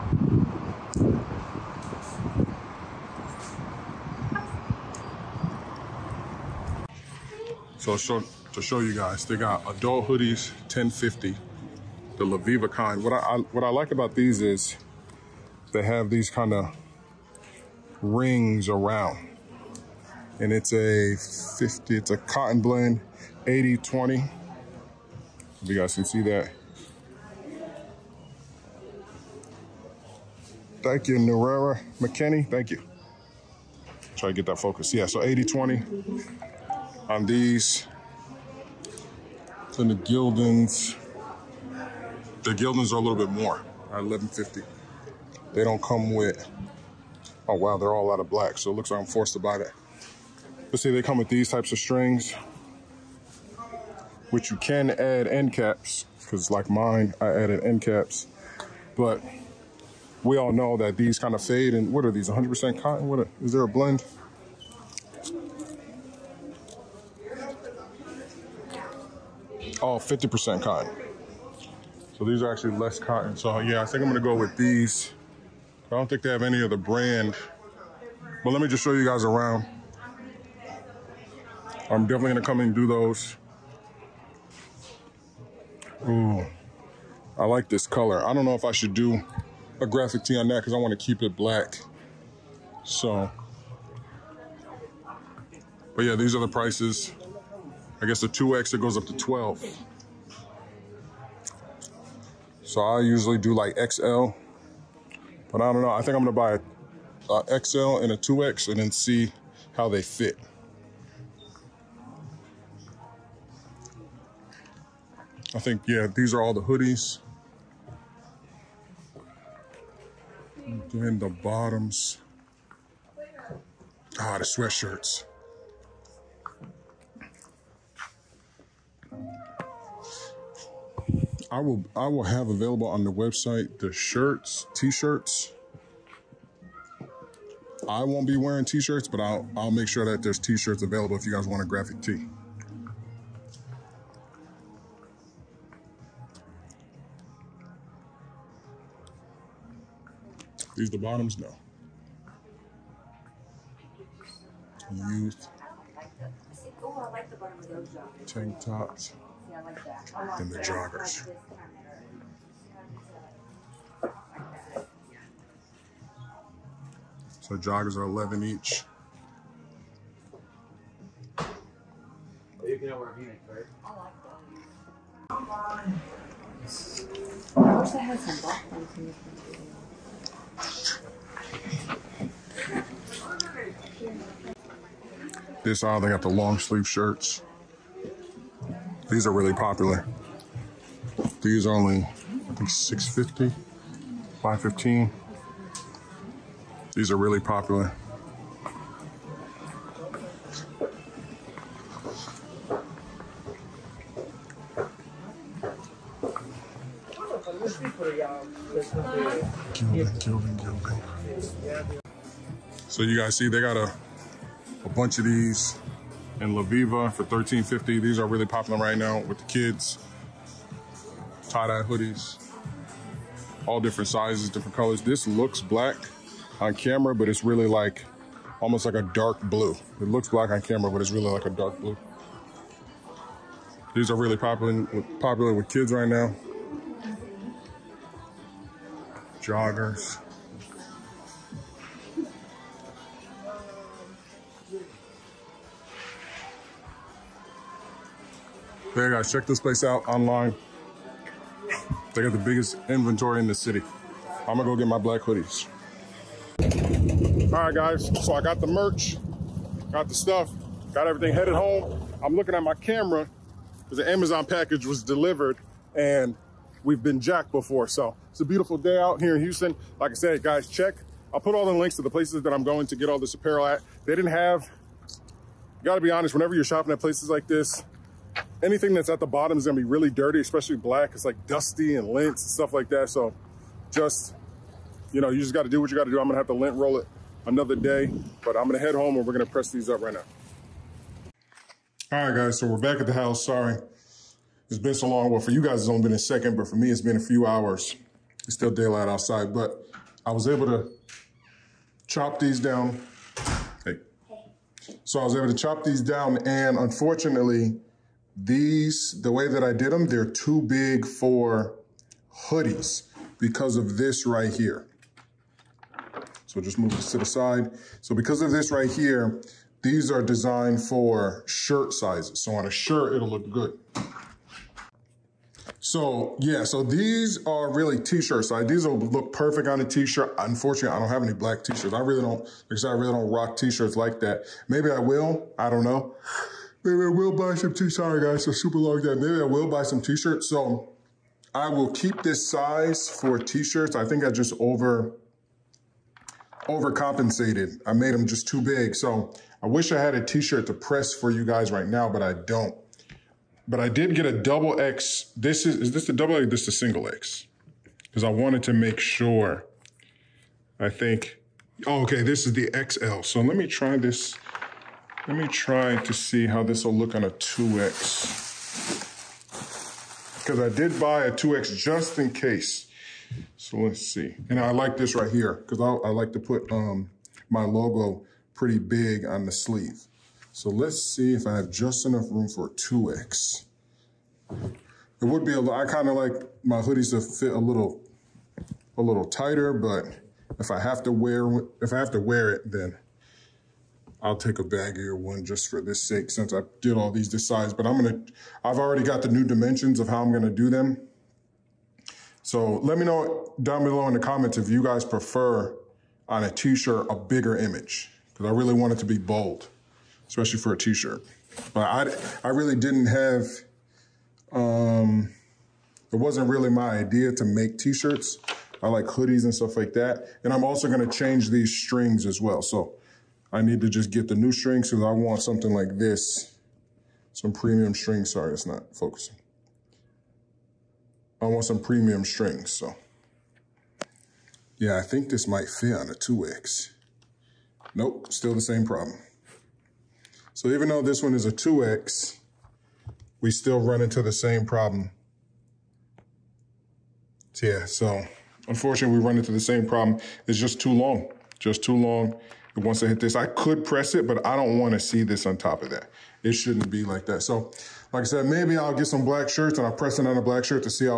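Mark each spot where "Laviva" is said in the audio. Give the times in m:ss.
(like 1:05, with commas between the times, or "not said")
0:12, 3:36.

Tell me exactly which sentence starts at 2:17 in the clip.
I won't be wearing t-shirts, but I'll I'll make sure that there's t-shirts available if you guys want a graphic tee.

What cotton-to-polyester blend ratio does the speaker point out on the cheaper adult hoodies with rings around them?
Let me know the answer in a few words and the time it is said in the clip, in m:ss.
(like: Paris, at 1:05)
80/20, at 0:21.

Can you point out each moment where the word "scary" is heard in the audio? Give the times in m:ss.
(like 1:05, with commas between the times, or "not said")
not said.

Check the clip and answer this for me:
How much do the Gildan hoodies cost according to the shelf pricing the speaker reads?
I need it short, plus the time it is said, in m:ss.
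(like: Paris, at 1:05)
$11.50, at 0:43.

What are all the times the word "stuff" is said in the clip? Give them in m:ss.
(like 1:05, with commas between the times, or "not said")
4:20, 4:42, 6:59.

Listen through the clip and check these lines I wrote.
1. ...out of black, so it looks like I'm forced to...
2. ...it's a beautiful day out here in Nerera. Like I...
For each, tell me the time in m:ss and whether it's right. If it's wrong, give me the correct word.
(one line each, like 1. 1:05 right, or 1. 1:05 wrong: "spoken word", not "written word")
1. 0:48 right
2. 4:28 wrong: "Houston", not "Nerera".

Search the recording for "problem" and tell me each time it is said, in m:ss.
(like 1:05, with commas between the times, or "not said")
7:18, 7:24, 7:29.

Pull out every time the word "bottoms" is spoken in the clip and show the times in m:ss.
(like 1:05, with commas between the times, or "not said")
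2:01, 2:30, 4:39.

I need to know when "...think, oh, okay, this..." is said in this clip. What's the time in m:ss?
6:00.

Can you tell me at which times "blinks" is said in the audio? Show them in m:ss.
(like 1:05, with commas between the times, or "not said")
not said.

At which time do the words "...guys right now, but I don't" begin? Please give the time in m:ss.
5:51.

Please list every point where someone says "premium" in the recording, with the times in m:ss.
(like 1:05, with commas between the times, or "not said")
7:07, 7:11.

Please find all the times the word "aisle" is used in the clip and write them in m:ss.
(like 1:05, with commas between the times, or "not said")
3:05.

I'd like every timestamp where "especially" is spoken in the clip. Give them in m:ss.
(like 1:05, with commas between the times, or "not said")
4:40, 6:50.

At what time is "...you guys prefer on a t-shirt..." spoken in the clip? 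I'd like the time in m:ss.
6:44.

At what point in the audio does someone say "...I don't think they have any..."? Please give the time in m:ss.
1:15.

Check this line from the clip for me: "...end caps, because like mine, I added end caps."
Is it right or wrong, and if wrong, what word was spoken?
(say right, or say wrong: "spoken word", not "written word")
right.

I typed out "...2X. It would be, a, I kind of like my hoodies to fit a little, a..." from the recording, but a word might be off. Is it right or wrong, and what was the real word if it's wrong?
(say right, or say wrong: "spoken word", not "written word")
right.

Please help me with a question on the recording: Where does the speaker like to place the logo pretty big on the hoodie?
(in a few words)
On the sleeve.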